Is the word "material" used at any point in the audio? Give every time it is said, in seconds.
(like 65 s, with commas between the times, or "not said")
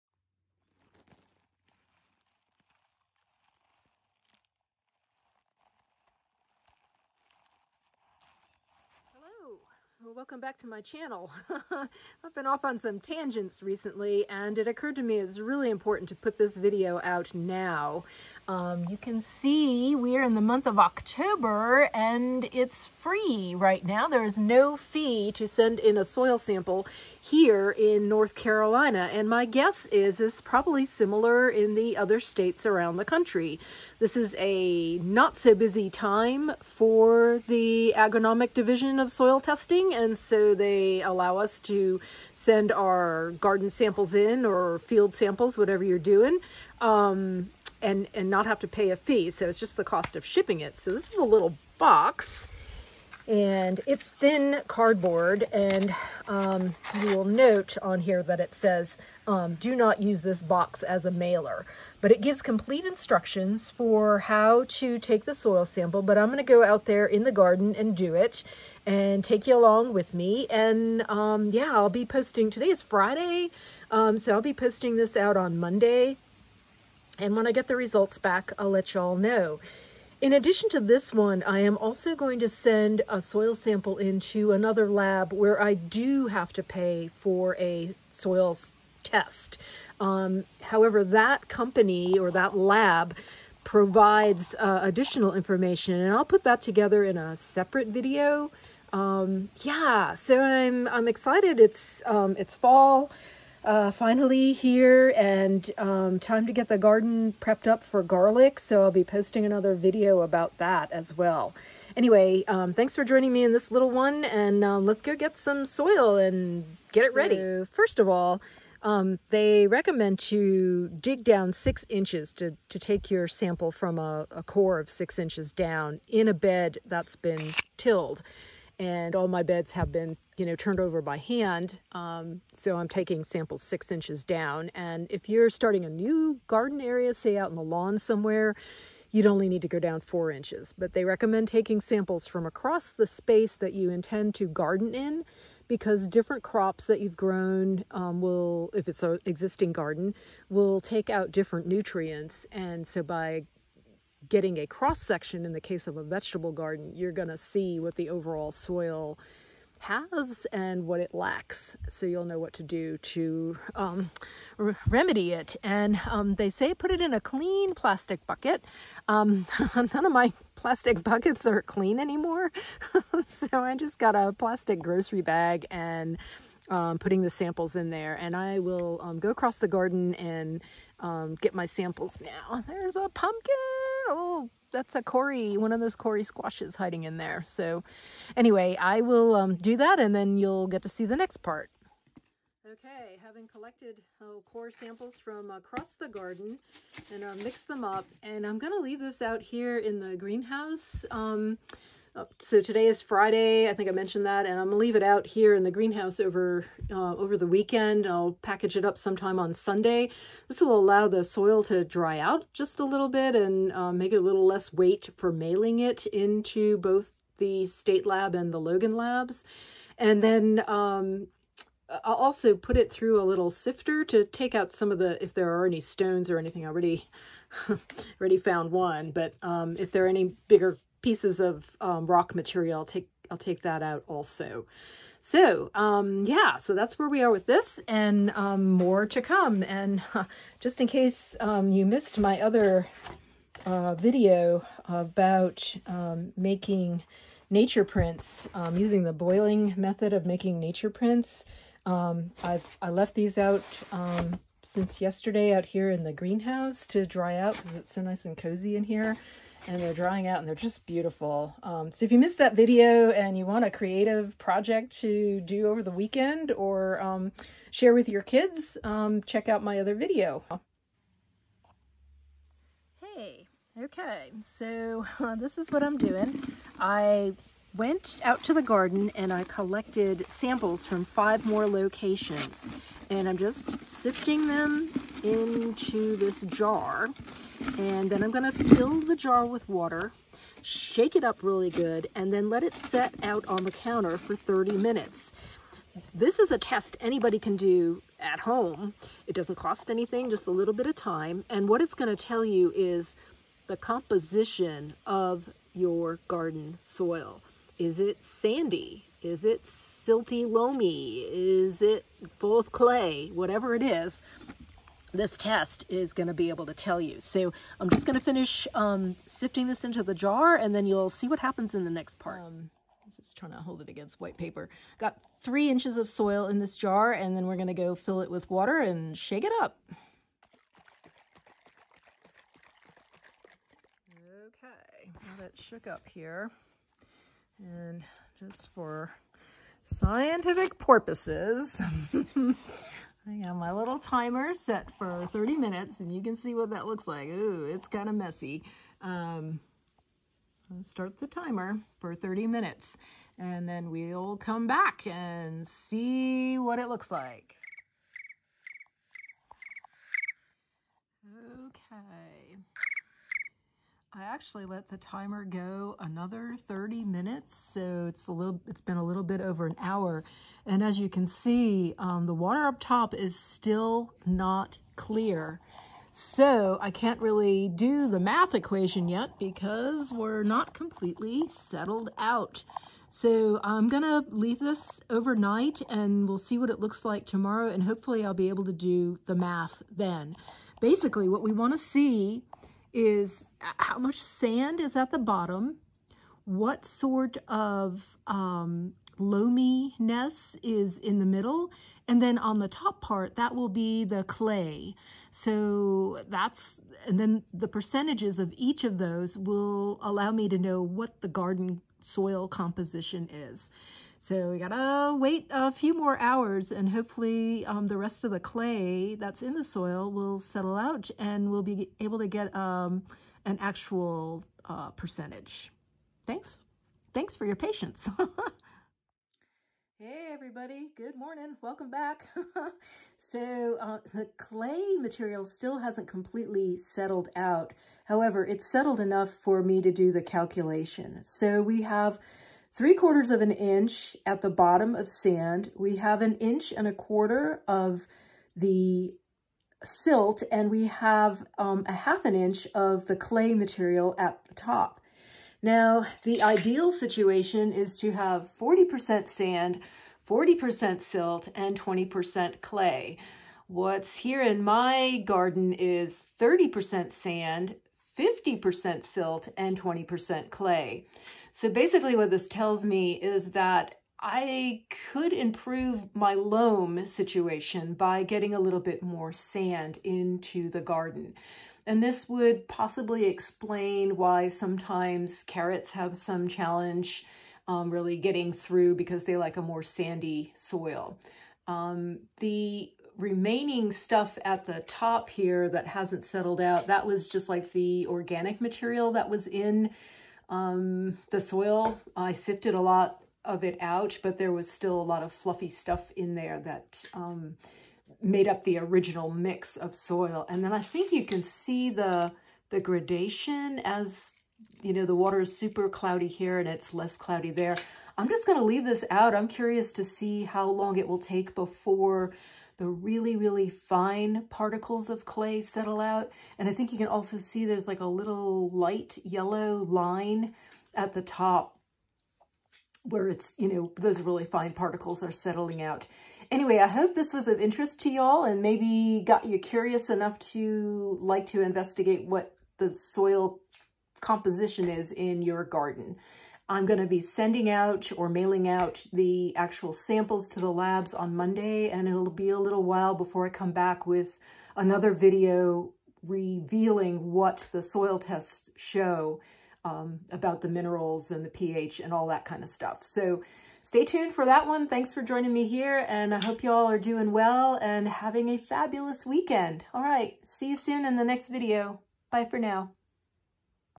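232 s, 434 s, 453 s, 498 s.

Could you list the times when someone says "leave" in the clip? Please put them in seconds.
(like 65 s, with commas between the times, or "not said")
198 s, 204 s, 384 s, 518 s.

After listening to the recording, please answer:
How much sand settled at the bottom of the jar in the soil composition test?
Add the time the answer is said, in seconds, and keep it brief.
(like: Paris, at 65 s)
three quarters of an inch, at 442 s.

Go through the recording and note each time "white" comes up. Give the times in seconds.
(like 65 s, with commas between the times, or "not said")
324 s.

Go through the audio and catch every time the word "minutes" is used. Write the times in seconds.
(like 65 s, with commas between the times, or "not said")
294 s, 345 s, 352 s, 367 s.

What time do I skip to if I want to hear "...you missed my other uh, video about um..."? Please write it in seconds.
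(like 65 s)
241 s.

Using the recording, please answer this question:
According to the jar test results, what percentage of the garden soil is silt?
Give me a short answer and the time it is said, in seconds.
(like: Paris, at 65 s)
50%, at 468 s.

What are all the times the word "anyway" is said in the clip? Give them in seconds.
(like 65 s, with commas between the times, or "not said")
111 s, 188 s, 536 s.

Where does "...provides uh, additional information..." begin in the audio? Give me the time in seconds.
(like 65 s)
93 s.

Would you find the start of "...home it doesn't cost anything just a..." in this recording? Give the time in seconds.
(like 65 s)
298 s.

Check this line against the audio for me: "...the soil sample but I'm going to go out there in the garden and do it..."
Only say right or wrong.
right.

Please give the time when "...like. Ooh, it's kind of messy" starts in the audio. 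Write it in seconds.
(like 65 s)
347 s.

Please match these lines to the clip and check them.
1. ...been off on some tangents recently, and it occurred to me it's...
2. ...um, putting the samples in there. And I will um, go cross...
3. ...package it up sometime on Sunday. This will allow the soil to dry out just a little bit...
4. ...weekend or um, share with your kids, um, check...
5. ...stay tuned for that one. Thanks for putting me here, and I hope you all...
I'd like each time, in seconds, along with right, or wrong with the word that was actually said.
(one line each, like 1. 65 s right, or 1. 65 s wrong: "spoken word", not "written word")
1. 12 s right
2. 176 s wrong: "across", not "cross"
3. 208 s right
4. 265 s right
5. 563 s wrong: "joining", not "putting".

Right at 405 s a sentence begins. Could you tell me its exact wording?
So that's, and then the percentages of each of those will allow me to know what the garden soil composition is.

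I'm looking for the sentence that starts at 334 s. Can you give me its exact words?
Okay, now that shook up here.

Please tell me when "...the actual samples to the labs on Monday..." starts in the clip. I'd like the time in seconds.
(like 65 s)
549 s.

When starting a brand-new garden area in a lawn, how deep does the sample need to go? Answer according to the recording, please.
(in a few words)
four inches.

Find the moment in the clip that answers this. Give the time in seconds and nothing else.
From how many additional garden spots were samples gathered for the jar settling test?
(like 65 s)
281 s.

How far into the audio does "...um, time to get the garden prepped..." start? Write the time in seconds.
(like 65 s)
105 s.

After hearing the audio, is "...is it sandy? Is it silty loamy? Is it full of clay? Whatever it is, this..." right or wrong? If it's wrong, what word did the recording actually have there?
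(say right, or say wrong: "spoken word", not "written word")
right.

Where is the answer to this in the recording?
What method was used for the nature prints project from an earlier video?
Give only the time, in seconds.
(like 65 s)
249 s.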